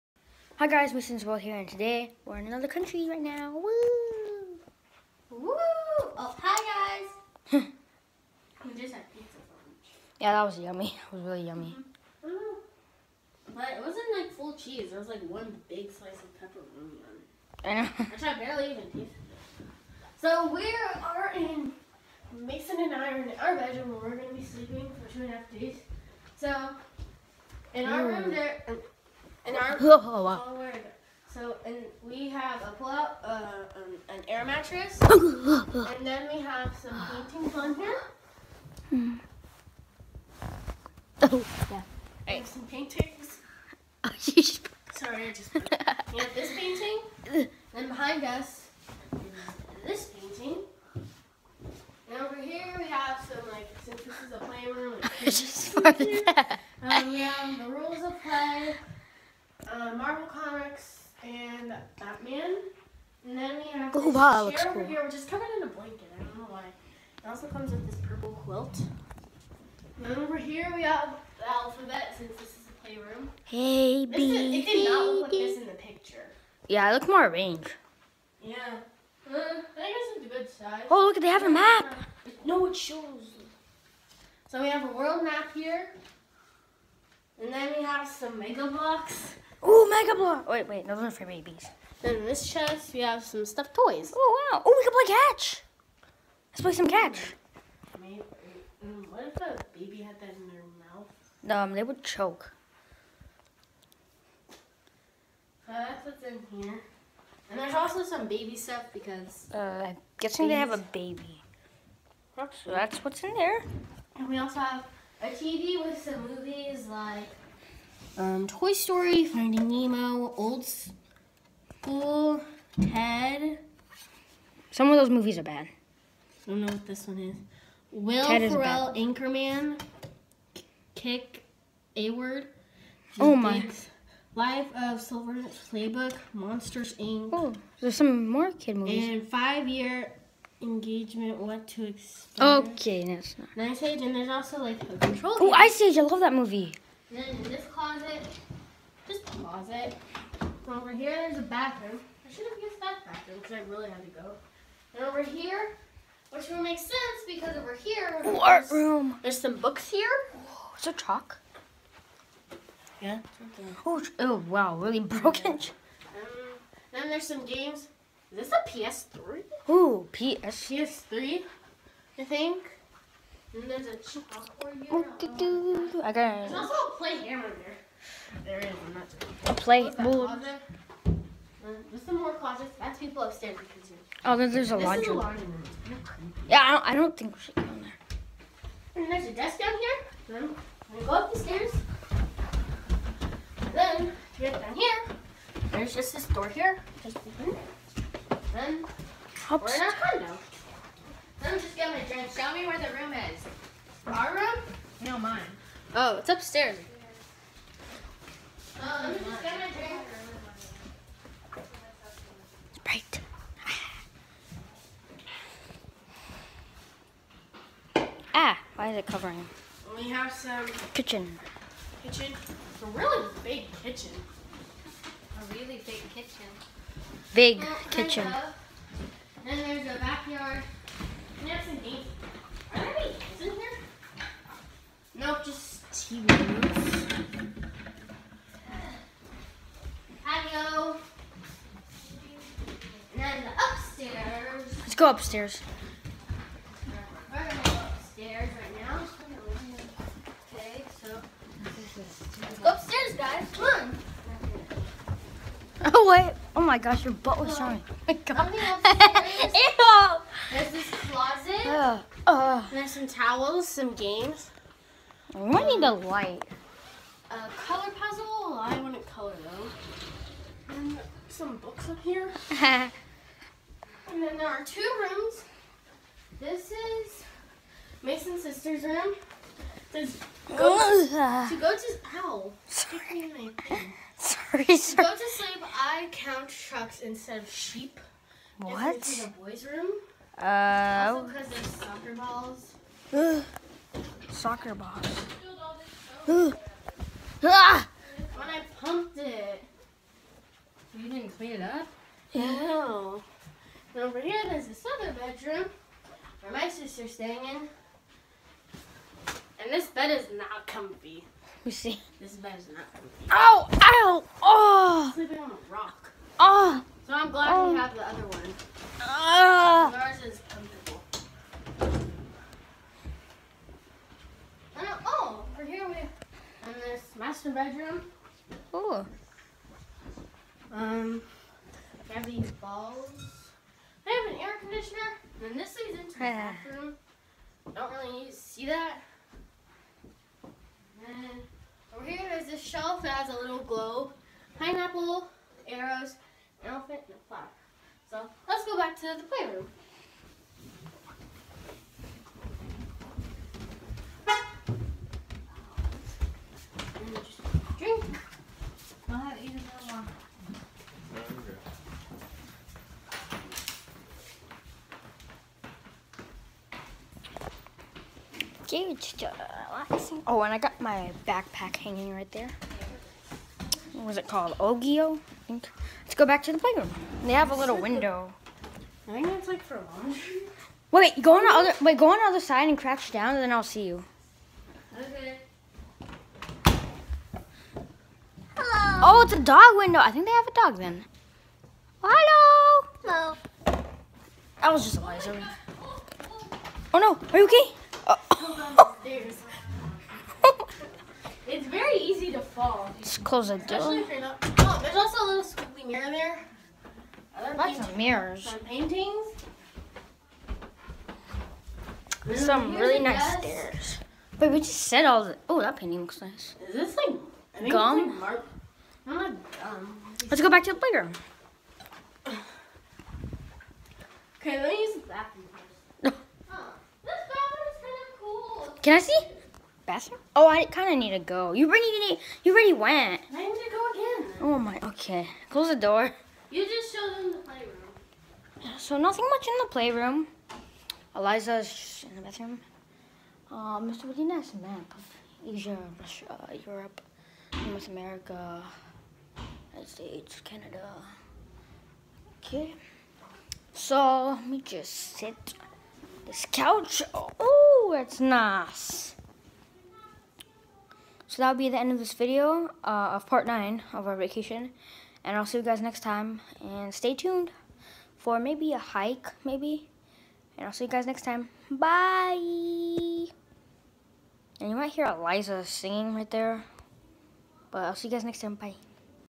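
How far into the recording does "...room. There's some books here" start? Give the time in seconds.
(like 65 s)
158 s.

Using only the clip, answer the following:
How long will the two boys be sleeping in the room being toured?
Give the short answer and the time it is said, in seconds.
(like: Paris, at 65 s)
Two and a half days, at 25 s.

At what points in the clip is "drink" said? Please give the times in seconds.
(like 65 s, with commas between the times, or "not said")
202 s, 209 s, 357 s.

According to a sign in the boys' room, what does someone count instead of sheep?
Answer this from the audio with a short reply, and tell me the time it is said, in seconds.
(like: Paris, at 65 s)
Trucks, at 286 s.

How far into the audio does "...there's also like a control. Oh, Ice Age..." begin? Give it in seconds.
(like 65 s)
144 s.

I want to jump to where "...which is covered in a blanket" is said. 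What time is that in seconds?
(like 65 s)
65 s.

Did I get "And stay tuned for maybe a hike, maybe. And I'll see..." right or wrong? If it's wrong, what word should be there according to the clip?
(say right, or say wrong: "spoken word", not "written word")
right.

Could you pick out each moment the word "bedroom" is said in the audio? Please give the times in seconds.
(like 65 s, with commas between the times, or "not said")
23 s, 305 s, 327 s.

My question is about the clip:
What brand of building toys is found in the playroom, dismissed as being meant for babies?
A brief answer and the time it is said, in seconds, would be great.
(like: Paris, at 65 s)
Mega Bloks, at 88 s.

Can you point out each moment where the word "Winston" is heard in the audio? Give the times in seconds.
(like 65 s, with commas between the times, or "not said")
0 s.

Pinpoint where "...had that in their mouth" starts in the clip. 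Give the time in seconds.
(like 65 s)
99 s.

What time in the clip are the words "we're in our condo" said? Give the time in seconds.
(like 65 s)
199 s.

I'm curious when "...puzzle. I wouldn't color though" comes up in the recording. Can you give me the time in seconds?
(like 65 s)
267 s.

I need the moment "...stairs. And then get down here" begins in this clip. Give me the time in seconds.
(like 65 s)
191 s.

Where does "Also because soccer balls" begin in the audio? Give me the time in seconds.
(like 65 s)
291 s.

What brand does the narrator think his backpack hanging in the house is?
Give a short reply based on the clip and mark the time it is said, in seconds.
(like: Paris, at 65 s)
Ogio, at 374 s.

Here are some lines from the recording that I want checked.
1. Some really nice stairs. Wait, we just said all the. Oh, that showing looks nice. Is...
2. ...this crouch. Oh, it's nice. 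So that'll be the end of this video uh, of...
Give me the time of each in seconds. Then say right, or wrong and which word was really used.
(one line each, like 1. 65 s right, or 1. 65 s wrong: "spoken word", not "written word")
1. 412 s wrong: "painting", not "showing"
2. 456 s wrong: "couch", not "crouch".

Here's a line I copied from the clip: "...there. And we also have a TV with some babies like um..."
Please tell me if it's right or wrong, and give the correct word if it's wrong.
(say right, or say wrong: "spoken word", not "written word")
wrong: "movies", not "babies".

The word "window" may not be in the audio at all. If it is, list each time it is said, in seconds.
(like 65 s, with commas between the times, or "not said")
377 s, 389 s.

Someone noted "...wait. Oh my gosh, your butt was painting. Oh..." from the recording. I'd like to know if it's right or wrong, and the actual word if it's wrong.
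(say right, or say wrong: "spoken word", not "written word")
wrong: "showing", not "painting".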